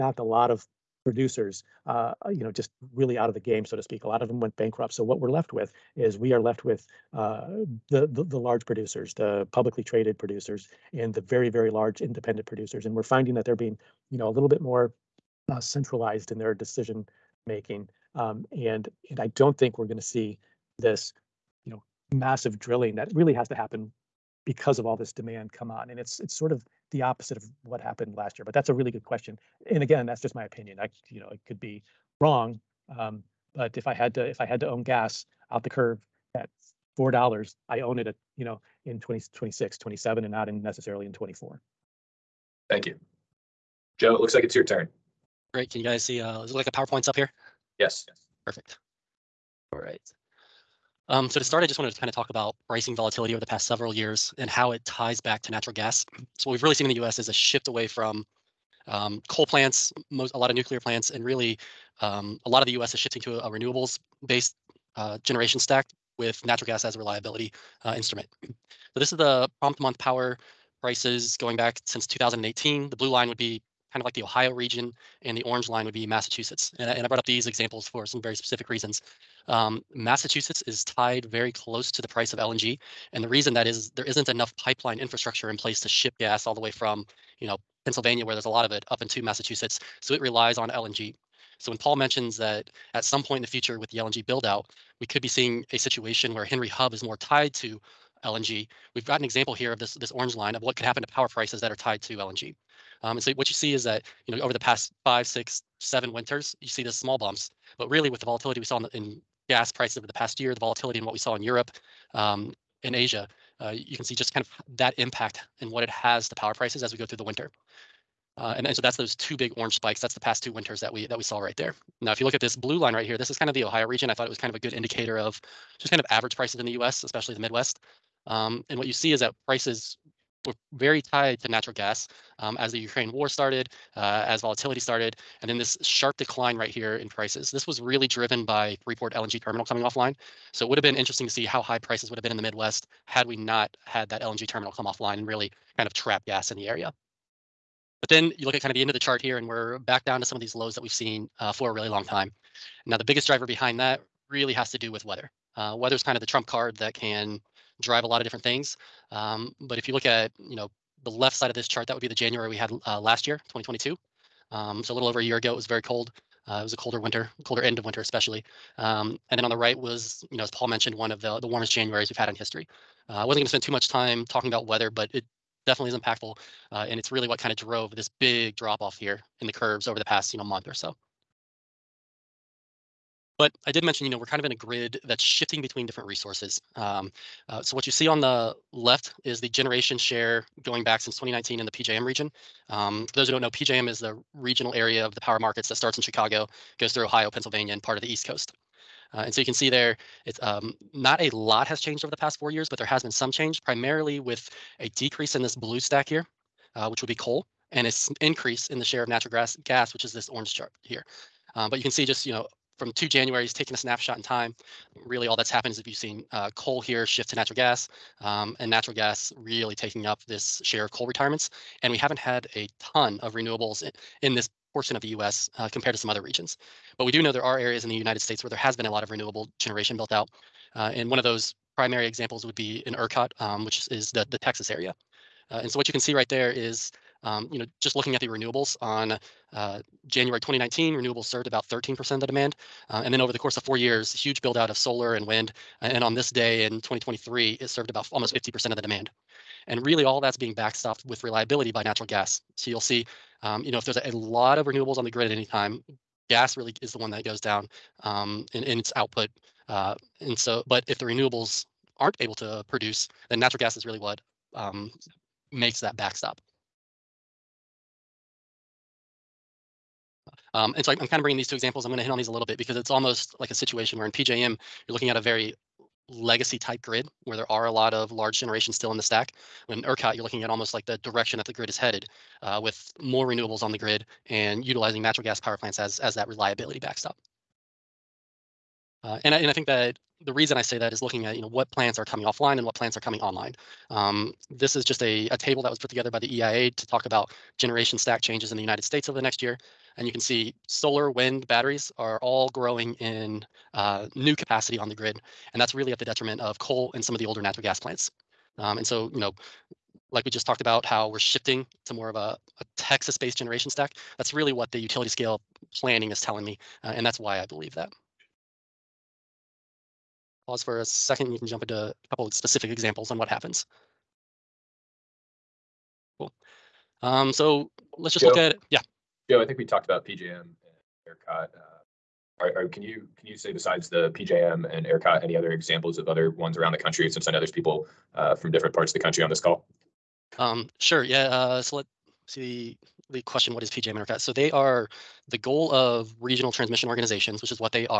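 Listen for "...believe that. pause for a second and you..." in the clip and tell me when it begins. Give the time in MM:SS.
05:17.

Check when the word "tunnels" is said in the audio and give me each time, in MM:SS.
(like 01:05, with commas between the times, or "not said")
not said.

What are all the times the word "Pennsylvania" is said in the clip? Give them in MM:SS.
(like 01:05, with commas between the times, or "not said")
01:27, 03:17.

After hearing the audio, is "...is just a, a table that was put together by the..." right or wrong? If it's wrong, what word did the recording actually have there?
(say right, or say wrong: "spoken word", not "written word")
right.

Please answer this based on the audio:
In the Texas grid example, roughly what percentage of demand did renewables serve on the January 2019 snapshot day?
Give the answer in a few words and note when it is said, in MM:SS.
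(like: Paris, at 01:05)
13%, at 04:01.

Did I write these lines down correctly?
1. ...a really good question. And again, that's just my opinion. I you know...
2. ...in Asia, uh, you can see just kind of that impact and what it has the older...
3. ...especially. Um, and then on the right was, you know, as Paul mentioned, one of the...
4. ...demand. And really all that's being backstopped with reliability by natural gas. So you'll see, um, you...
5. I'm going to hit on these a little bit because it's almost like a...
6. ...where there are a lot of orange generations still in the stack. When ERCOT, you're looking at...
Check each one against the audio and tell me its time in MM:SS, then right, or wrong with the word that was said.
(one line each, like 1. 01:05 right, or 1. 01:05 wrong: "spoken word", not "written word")
1. 00:28 right
2. 01:52 wrong: "power", not "older"
3. 02:48 right
4. 04:08 right
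5. 04:31 right
6. 04:37 wrong: "large", not "orange".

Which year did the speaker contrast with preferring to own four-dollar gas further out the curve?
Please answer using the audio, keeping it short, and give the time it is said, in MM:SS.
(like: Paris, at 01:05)
2024, at 00:41.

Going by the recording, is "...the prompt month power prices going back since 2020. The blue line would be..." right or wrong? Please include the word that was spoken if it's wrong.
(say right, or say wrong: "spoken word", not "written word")
wrong: "2018", not "2020".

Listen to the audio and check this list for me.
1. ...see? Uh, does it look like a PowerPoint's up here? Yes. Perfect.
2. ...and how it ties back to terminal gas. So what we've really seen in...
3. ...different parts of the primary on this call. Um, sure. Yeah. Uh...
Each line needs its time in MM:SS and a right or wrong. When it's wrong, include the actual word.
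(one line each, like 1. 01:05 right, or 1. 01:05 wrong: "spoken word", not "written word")
1. 00:46 right
2. 00:54 wrong: "natural", not "terminal"
3. 05:38 wrong: "country", not "primary".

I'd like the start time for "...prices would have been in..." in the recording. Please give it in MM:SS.
02:21.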